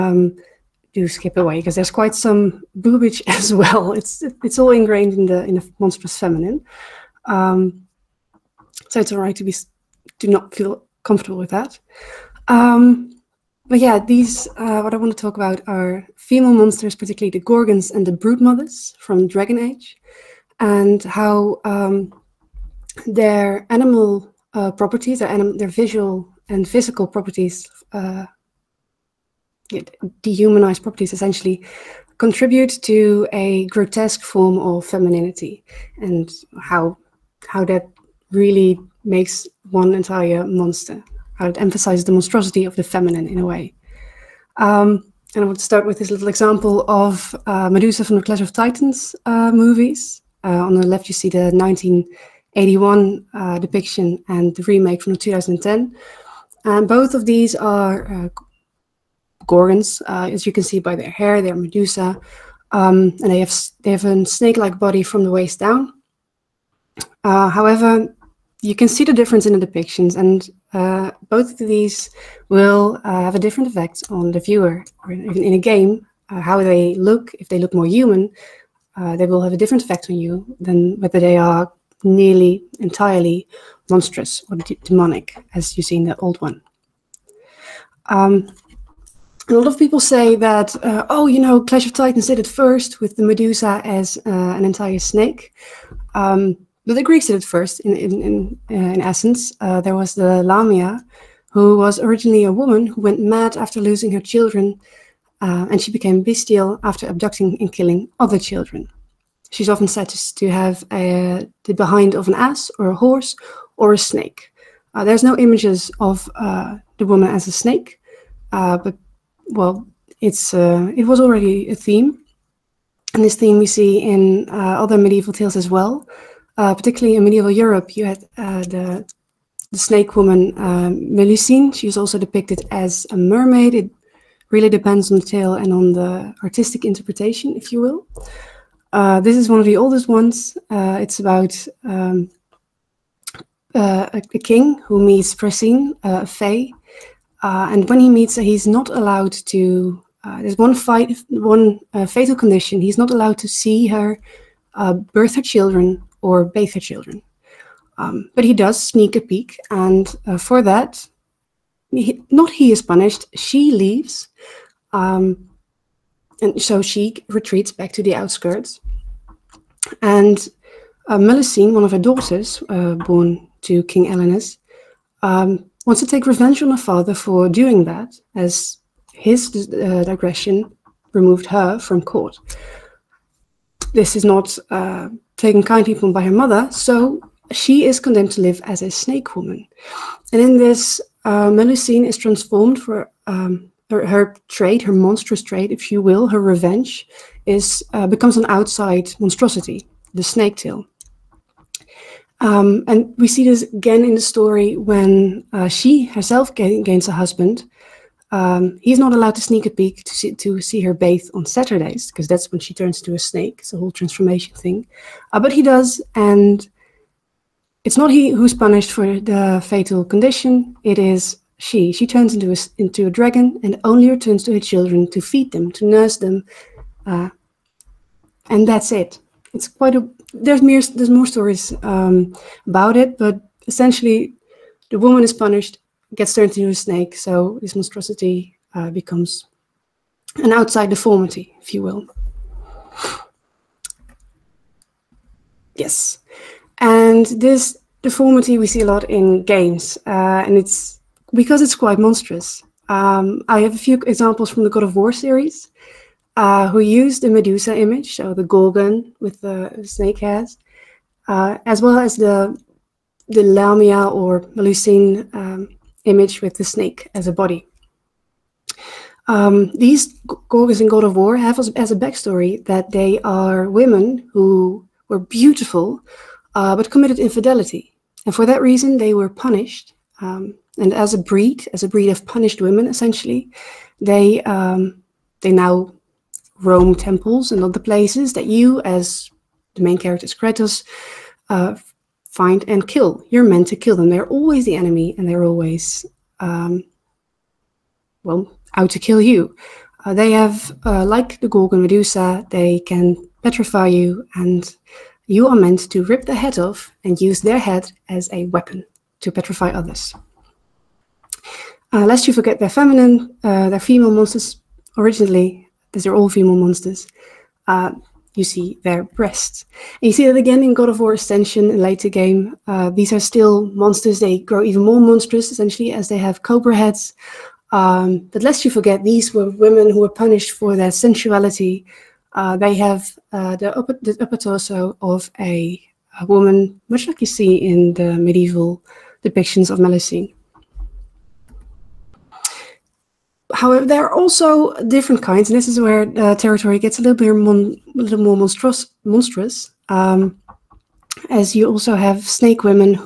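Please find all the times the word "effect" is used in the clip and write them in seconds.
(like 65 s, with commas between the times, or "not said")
73 s, 79 s.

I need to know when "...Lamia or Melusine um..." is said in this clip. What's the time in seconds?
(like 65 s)
263 s.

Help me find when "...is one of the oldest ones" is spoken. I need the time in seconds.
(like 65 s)
139 s.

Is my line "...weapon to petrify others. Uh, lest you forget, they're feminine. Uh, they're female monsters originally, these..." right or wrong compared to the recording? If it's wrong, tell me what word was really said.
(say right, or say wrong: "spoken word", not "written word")
right.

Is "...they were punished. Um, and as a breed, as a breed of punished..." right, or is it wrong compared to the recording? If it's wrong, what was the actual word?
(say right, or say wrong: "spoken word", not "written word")
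right.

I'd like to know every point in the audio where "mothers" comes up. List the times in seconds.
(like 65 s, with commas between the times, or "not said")
18 s, 186 s.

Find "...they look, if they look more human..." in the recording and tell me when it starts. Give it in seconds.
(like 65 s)
76 s.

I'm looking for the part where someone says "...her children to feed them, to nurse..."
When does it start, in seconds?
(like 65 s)
224 s.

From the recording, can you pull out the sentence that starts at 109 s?
She's often said to have a, uh, the behind of an ass or a horse or a snake.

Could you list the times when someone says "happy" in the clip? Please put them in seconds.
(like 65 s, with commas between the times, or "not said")
not said.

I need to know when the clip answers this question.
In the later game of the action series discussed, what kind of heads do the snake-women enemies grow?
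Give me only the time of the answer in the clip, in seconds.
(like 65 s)
326 s.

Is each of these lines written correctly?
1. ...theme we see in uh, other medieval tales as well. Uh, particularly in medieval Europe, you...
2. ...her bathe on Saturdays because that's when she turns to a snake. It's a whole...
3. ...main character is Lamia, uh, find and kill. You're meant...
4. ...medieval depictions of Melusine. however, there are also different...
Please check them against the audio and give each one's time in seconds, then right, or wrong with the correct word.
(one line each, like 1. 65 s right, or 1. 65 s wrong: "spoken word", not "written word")
1. 123 s right
2. 210 s right
3. 289 s wrong: "Kratos", not "Lamia"
4. 338 s right.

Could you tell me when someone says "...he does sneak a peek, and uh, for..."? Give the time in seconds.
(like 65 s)
158 s.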